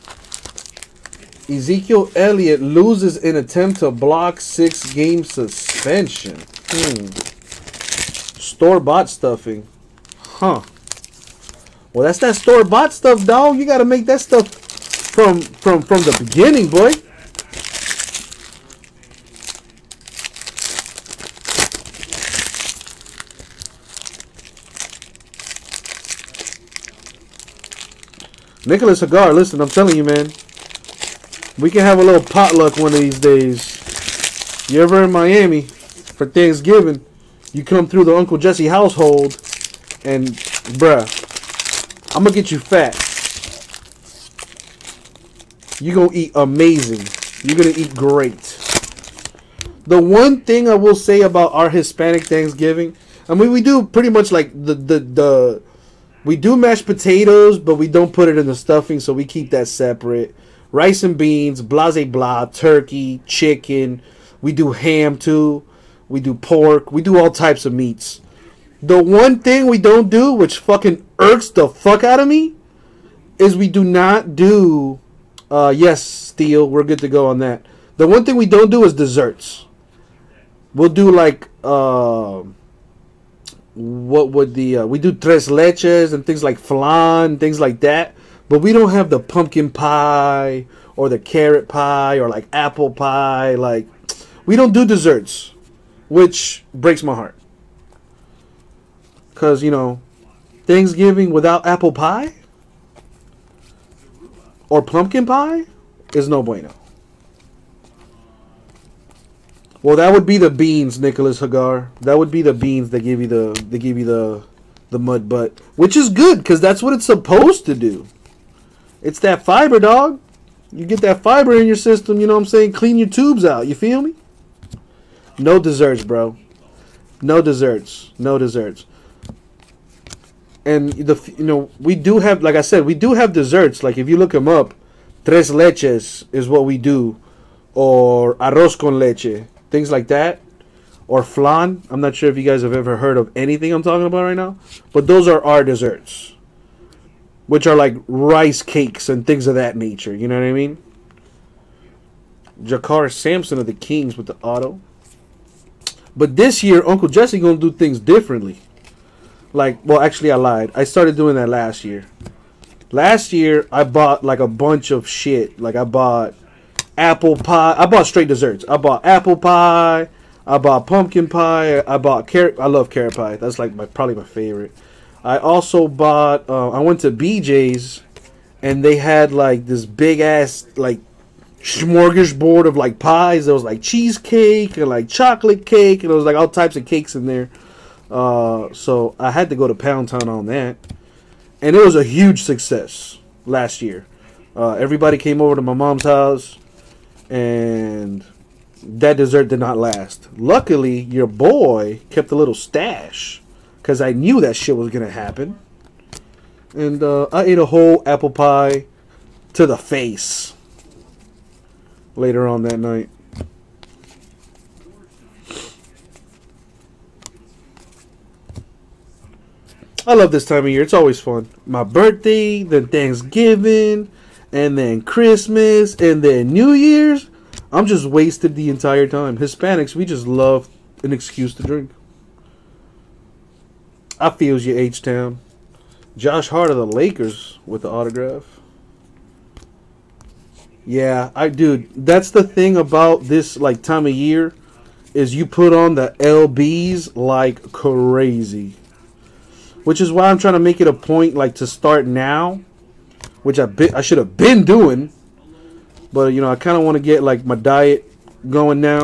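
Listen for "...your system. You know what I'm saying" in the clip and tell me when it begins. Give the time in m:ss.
2:01.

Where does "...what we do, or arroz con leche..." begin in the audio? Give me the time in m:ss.
2:16.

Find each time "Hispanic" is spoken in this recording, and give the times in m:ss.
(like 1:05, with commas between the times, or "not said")
0:51, 3:49.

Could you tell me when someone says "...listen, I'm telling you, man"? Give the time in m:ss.
0:29.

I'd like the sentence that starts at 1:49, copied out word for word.
Well, that would be the beans, Nicholas Hagar.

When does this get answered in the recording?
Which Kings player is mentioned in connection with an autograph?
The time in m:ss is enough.
2:32.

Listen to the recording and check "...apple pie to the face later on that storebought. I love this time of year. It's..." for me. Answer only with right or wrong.
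wrong.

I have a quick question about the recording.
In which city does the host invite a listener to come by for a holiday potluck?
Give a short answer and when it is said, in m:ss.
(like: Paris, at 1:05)
Miami, at 0:35.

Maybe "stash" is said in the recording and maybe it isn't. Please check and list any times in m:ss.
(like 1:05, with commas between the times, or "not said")
3:22.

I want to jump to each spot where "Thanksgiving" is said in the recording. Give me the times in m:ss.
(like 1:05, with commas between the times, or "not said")
0:36, 0:52, 1:40, 3:42.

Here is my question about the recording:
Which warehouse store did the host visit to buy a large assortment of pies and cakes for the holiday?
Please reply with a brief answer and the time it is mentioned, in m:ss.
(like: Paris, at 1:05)
BJ's, at 2:57.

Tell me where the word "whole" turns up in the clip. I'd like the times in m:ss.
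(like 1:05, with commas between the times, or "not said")
3:27.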